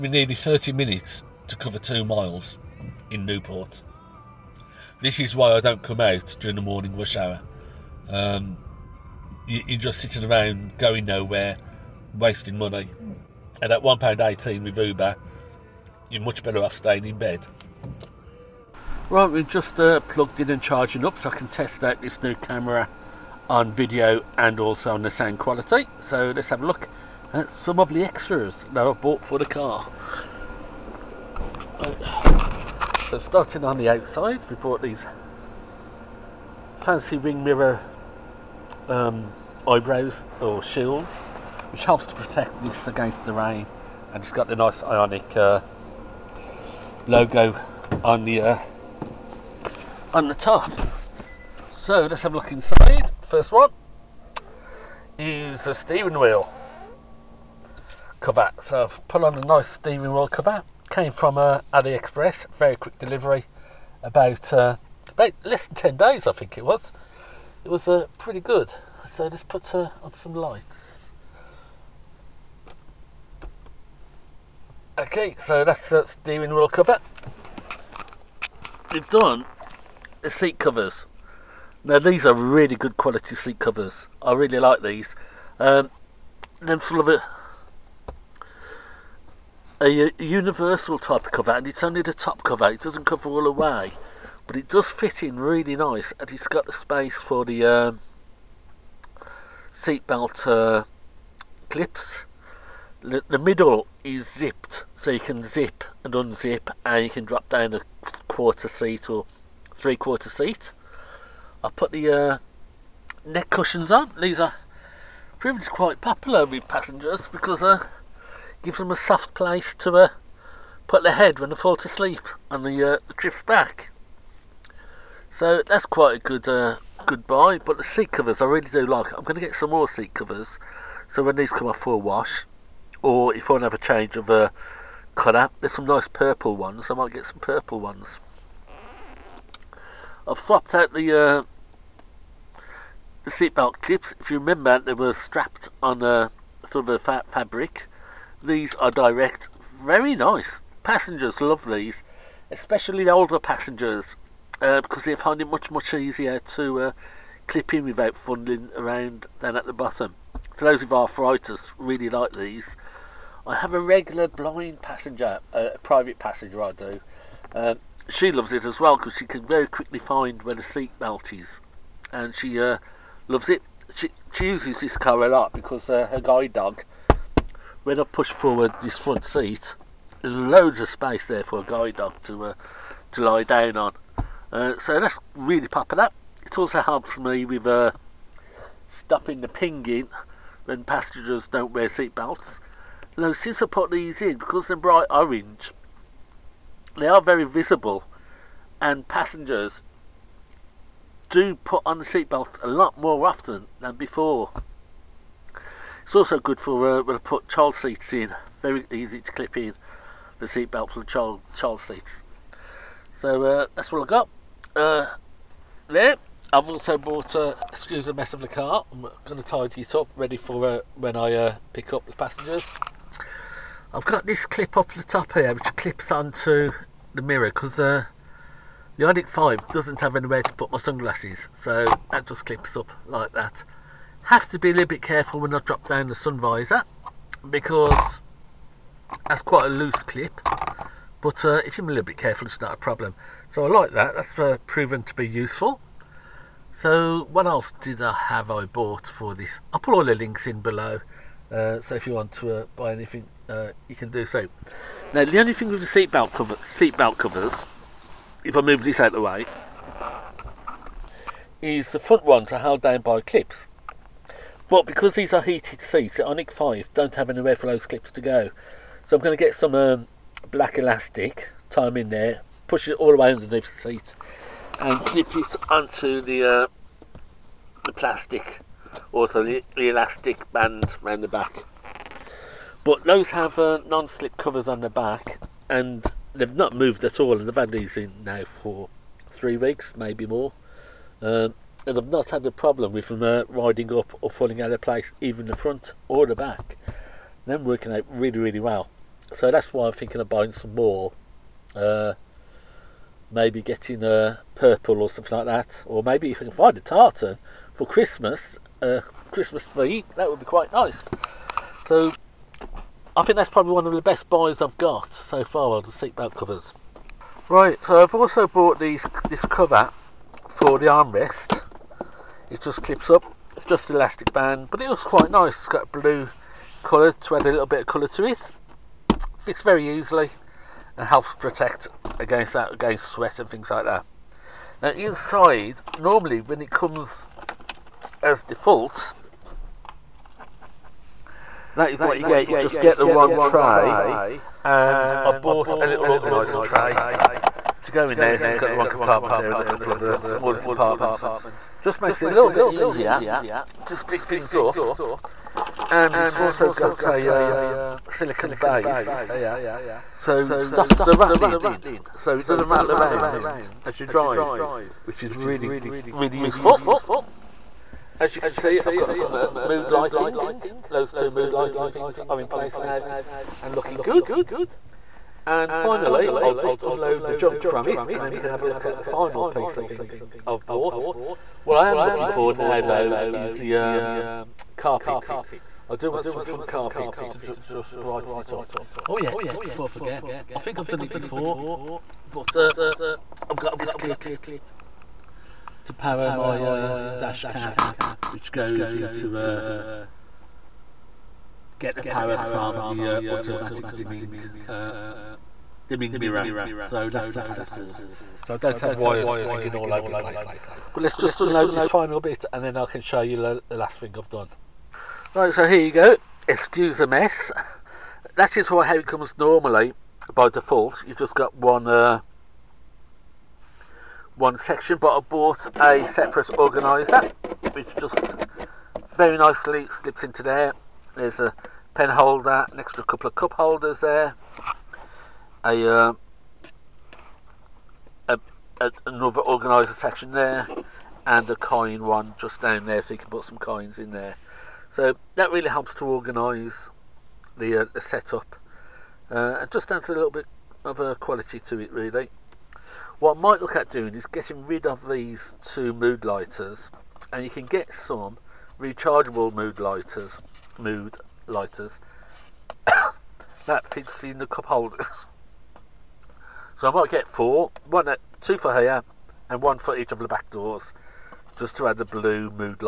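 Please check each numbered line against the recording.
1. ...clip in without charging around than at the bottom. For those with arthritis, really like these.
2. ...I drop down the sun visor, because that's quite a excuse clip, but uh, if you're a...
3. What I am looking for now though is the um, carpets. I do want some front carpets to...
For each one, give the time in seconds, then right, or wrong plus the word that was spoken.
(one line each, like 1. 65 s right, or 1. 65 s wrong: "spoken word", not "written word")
1. 157 s wrong: "fumbling", not "charging"
2. 235 s wrong: "loose", not "excuse"
3. 381 s right.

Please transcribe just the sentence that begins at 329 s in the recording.
Fits very easily and helps protect against that against sweat and things like that.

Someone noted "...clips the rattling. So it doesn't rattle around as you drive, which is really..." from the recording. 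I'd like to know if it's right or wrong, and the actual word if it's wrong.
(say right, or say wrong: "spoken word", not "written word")
wrong: "stops", not "clips".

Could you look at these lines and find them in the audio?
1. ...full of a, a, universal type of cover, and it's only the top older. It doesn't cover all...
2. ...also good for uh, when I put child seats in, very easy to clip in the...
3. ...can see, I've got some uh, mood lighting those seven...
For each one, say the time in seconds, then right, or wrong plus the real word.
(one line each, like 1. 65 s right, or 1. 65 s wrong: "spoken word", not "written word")
1. 86 s wrong: "cover", not "older"
2. 206 s right
3. 368 s wrong: "two", not "seven".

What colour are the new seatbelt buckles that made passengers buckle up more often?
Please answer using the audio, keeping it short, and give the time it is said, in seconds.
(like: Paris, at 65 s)
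Orange, at 194 s.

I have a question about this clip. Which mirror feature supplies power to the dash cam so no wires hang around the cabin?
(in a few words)
Automatic dimming.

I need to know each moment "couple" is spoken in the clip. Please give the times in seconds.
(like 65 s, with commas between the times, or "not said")
349 s, 433 s.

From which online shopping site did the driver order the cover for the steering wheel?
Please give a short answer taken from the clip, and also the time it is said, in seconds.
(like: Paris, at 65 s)
AliExpress, at 61 s.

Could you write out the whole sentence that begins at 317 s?
Right, so I've also bought these this cover for the armrest.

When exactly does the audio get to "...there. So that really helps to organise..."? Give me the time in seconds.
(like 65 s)
444 s.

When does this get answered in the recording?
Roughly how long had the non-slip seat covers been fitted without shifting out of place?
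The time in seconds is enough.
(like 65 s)
289 s.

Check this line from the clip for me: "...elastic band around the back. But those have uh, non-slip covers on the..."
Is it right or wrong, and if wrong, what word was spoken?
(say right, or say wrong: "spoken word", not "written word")
right.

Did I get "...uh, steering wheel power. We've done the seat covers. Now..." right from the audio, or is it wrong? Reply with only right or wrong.
wrong.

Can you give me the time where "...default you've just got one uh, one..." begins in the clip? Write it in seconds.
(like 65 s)
420 s.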